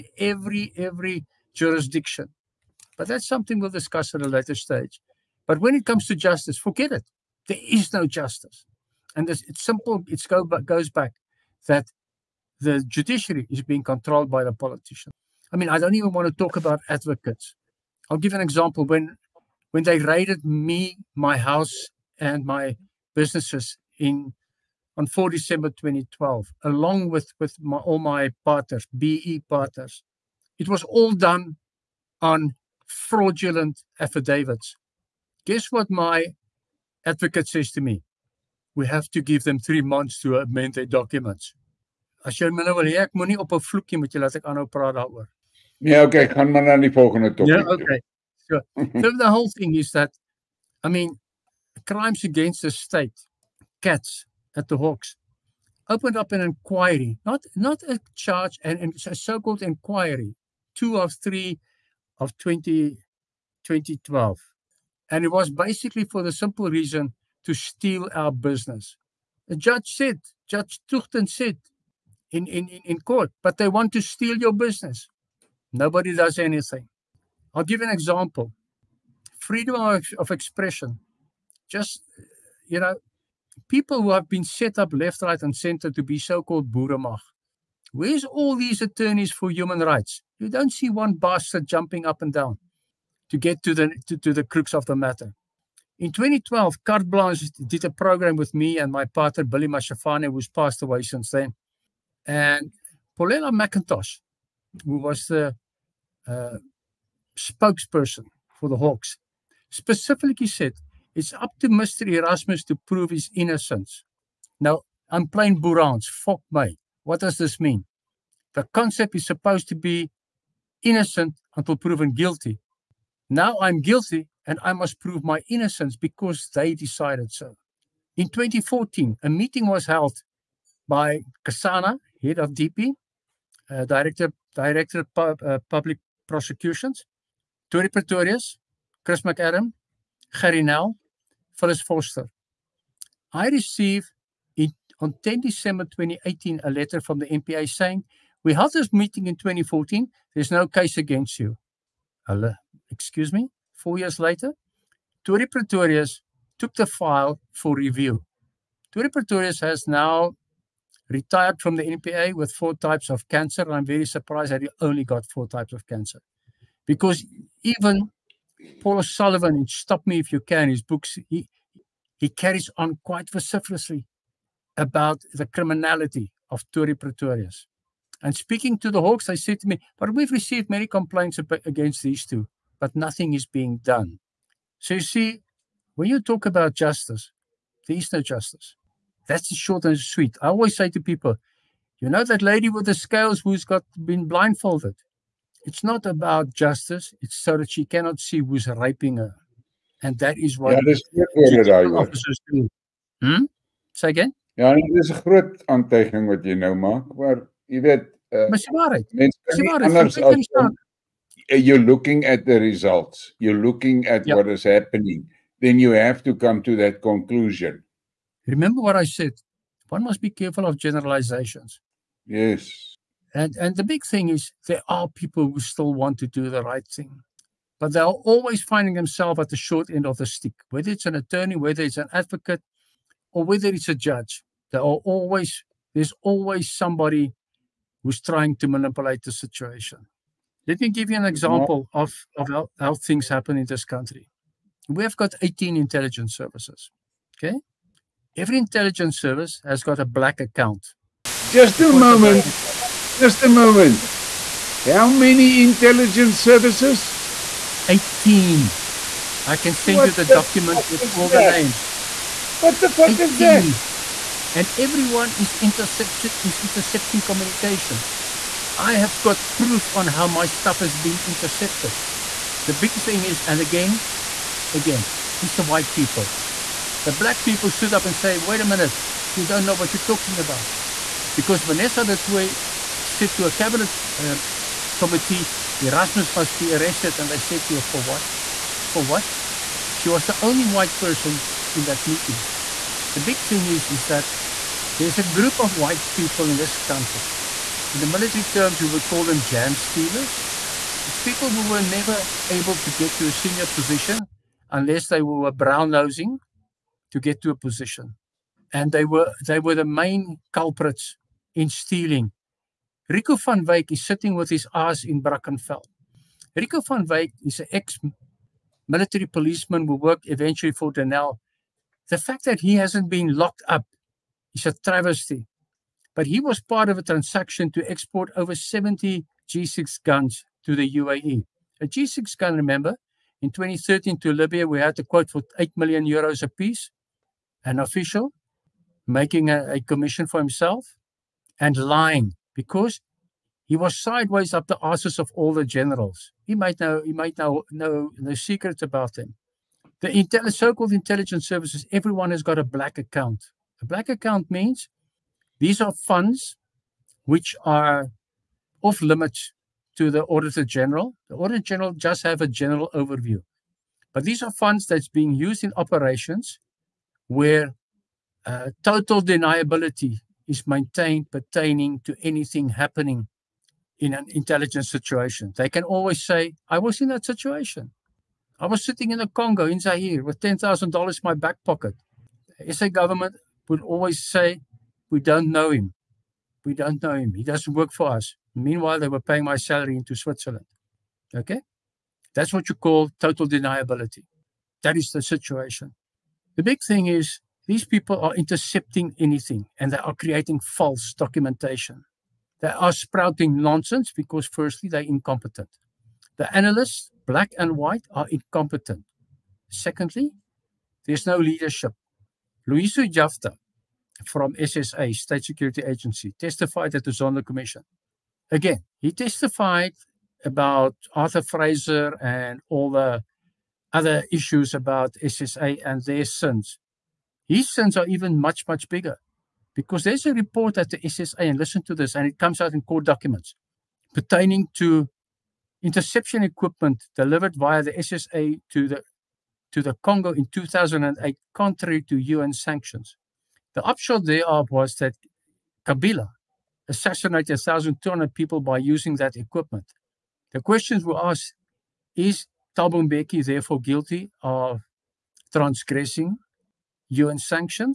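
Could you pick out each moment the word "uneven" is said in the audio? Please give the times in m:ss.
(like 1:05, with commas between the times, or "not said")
not said.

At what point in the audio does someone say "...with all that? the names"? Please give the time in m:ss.
4:20.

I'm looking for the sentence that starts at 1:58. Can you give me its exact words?
The concept is supposed to be innocent until proven guilty.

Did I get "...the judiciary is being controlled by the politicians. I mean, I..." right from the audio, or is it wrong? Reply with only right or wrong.
right.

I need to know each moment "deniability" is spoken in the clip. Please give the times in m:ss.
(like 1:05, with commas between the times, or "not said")
6:09, 6:33.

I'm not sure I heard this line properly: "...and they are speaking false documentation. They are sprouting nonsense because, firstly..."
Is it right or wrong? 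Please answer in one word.
wrong.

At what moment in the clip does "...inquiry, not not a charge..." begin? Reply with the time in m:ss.
0:56.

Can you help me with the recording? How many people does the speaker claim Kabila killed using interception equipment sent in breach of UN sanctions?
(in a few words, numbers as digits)
1,200.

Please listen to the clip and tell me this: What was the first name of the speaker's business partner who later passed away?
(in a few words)
Billy.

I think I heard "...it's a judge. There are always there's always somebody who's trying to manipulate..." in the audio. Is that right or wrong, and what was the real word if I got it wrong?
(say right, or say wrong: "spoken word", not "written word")
right.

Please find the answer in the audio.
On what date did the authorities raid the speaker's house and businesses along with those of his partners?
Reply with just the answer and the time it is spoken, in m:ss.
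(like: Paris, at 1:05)
4 December 2012, at 0:25.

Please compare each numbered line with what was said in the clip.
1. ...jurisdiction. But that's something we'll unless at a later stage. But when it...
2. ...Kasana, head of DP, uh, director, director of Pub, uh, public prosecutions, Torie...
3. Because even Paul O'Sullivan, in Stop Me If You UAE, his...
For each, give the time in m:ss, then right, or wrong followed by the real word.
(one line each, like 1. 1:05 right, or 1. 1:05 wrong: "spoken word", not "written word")
1. 0:01 wrong: "discuss", not "unless"
2. 2:11 right
3. 2:46 wrong: "Can", not "UAE".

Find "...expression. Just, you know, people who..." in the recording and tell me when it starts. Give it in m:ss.
1:20.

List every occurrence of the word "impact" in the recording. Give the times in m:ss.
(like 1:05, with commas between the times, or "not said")
not said.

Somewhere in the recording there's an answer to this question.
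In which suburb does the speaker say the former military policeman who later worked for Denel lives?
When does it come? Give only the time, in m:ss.
5:15.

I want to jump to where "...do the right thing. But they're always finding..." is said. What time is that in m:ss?
3:46.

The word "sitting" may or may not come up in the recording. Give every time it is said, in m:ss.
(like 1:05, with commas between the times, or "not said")
5:14, 6:18.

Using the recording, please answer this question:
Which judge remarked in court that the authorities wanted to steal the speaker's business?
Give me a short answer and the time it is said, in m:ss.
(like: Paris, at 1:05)
Judge Tuchten, at 1:10.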